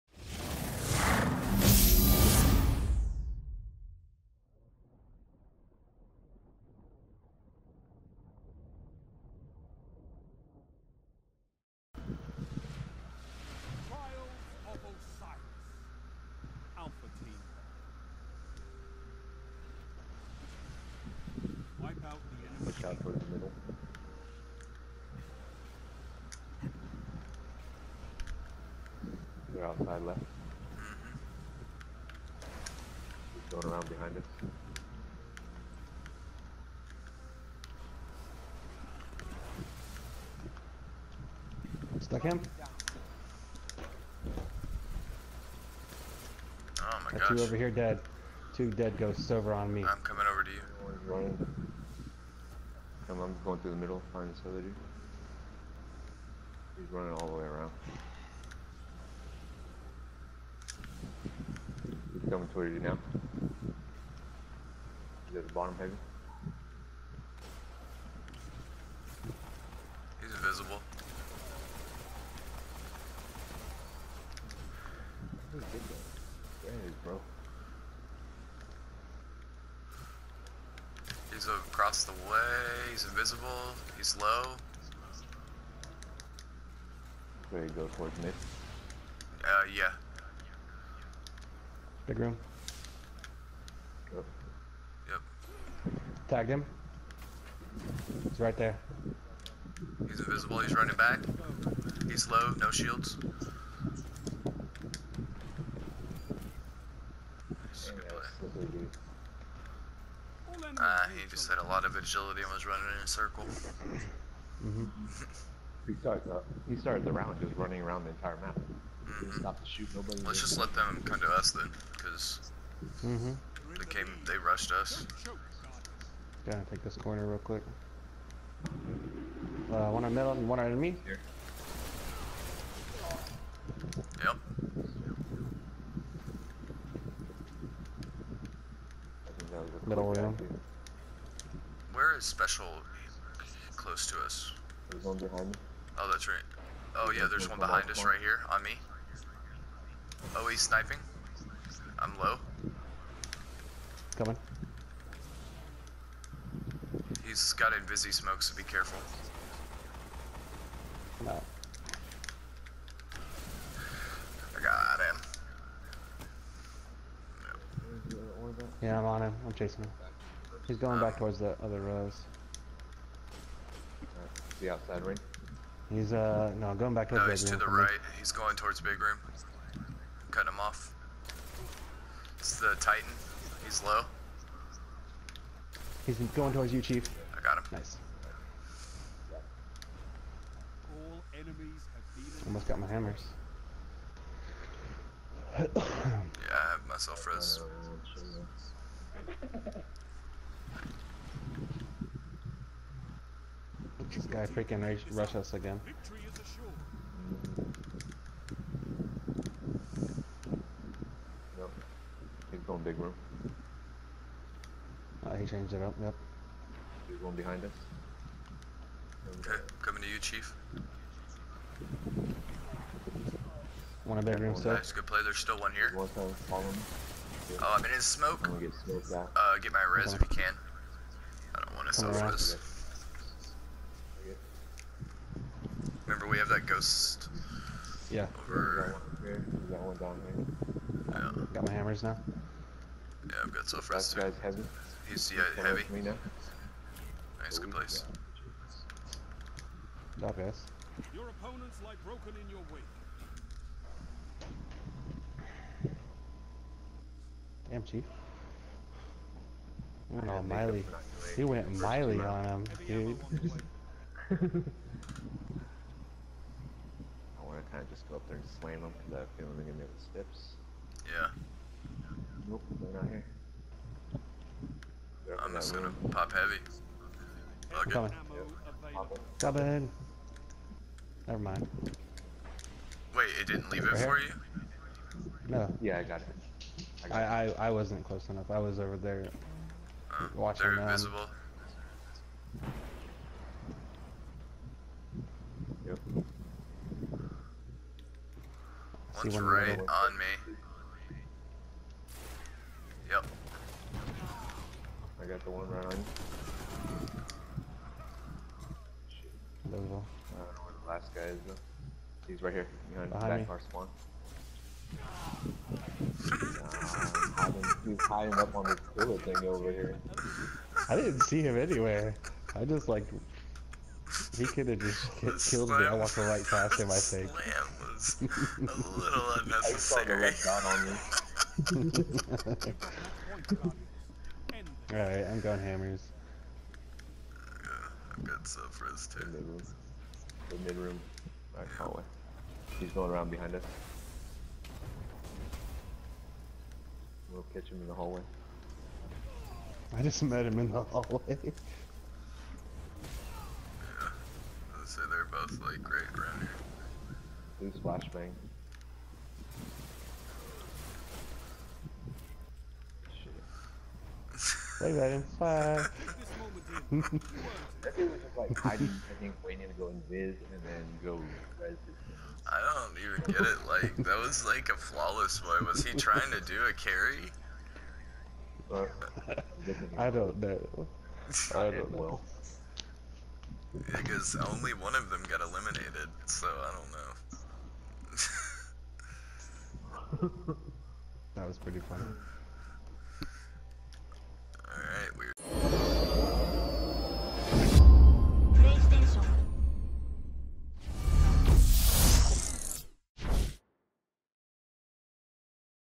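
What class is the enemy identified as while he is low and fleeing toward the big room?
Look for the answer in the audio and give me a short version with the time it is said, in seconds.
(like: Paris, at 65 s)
Titan, at 182 s.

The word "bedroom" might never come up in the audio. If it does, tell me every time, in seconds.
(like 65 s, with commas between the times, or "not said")
224 s.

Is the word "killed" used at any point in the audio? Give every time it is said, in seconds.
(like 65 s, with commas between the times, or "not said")
325 s.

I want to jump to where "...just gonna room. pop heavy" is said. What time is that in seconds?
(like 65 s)
275 s.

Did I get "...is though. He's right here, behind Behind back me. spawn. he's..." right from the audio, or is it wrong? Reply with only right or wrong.
right.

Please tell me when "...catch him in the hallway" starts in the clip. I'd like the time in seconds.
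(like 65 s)
347 s.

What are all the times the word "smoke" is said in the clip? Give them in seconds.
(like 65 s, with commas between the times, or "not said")
158 s, 228 s.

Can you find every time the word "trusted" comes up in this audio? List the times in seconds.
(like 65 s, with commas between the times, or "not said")
not said.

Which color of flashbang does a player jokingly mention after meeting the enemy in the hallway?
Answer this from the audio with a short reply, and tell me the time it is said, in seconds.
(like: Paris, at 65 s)
Blue, at 357 s.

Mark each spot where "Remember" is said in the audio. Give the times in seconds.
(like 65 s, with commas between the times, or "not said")
236 s.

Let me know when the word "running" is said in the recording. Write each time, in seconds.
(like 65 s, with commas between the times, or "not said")
51 s, 56 s, 100 s, 112 s, 117 s.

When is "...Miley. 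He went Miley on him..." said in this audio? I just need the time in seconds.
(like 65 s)
260 s.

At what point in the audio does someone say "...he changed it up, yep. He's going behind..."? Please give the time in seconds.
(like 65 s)
215 s.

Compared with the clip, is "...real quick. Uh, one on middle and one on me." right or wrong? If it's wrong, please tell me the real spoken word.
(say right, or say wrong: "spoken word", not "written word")
right.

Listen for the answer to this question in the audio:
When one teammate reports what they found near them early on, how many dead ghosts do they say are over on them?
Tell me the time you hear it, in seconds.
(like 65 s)
48 s.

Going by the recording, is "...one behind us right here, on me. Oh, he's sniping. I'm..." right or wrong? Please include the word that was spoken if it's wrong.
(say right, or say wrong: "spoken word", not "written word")
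right.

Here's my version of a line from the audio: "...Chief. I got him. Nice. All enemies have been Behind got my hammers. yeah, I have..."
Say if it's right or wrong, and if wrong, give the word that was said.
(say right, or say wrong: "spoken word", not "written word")
wrong: "Almost", not "Behind".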